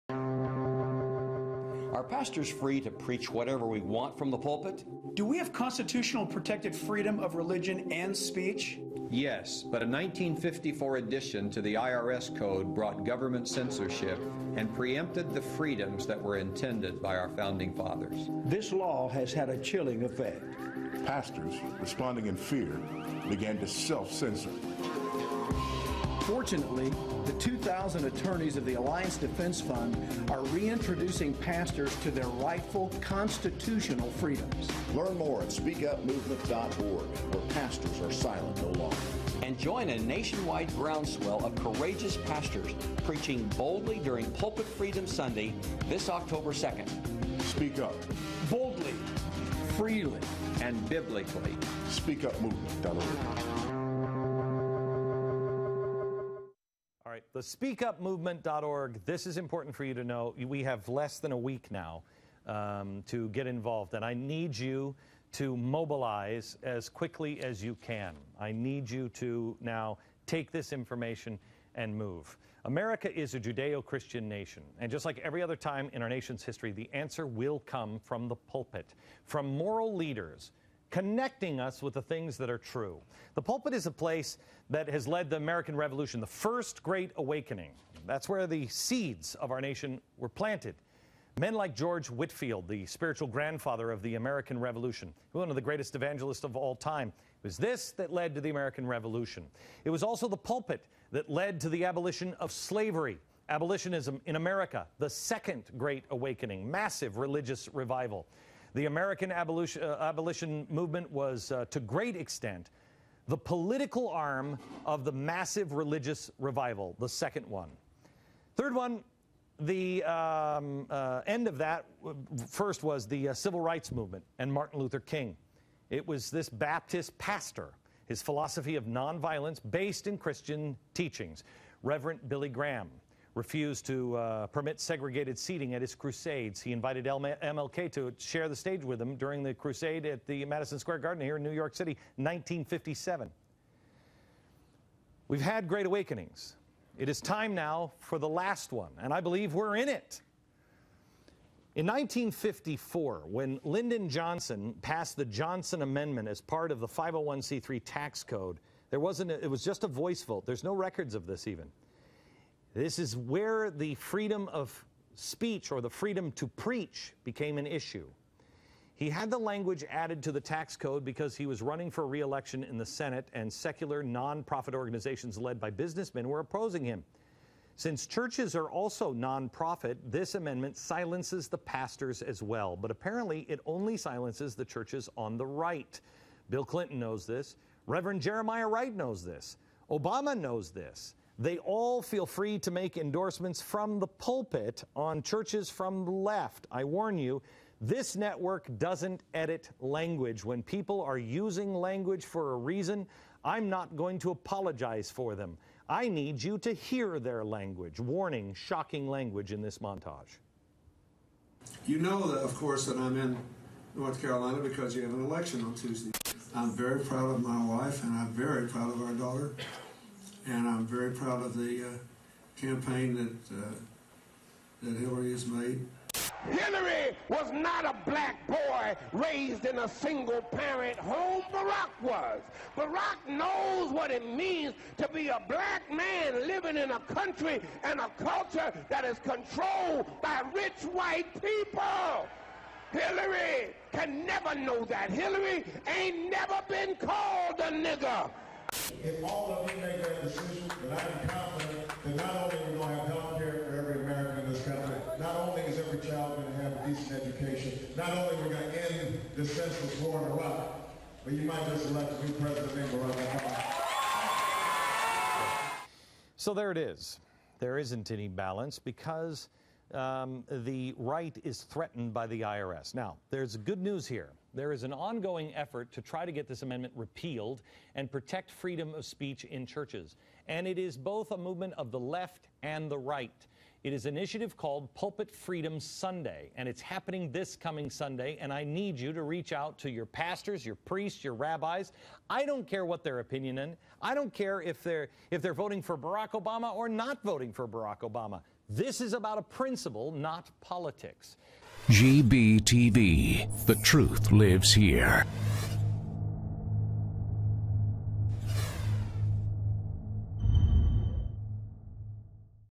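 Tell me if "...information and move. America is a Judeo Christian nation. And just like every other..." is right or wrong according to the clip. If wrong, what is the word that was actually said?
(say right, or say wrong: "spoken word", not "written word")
right.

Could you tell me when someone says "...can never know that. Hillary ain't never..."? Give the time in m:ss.
4:03.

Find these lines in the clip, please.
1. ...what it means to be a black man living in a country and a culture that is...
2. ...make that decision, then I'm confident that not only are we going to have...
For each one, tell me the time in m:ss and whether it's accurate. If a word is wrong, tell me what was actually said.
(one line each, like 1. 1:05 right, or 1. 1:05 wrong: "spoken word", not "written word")
1. 3:53 right
2. 4:09 right.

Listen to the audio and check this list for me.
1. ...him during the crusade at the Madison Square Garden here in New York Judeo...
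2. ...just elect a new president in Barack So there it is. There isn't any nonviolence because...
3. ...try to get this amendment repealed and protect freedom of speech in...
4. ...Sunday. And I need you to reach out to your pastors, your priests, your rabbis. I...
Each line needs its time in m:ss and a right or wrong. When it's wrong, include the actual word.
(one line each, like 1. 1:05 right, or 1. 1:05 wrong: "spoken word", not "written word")
1. 2:19 wrong: "City", not "Judeo"
2. 4:21 wrong: "balance", not "nonviolence"
3. 4:36 right
4. 4:47 right.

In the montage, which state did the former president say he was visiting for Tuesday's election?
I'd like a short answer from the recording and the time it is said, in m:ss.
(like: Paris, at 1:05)
North Carolina, at 3:33.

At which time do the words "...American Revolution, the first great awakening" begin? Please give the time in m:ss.
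1:25.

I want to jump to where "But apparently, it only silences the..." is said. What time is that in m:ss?
3:02.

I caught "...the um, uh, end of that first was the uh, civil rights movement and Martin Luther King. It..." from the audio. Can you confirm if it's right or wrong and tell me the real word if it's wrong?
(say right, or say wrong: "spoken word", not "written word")
right.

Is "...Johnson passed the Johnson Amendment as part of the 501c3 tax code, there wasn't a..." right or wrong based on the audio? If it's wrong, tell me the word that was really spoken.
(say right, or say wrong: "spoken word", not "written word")
right.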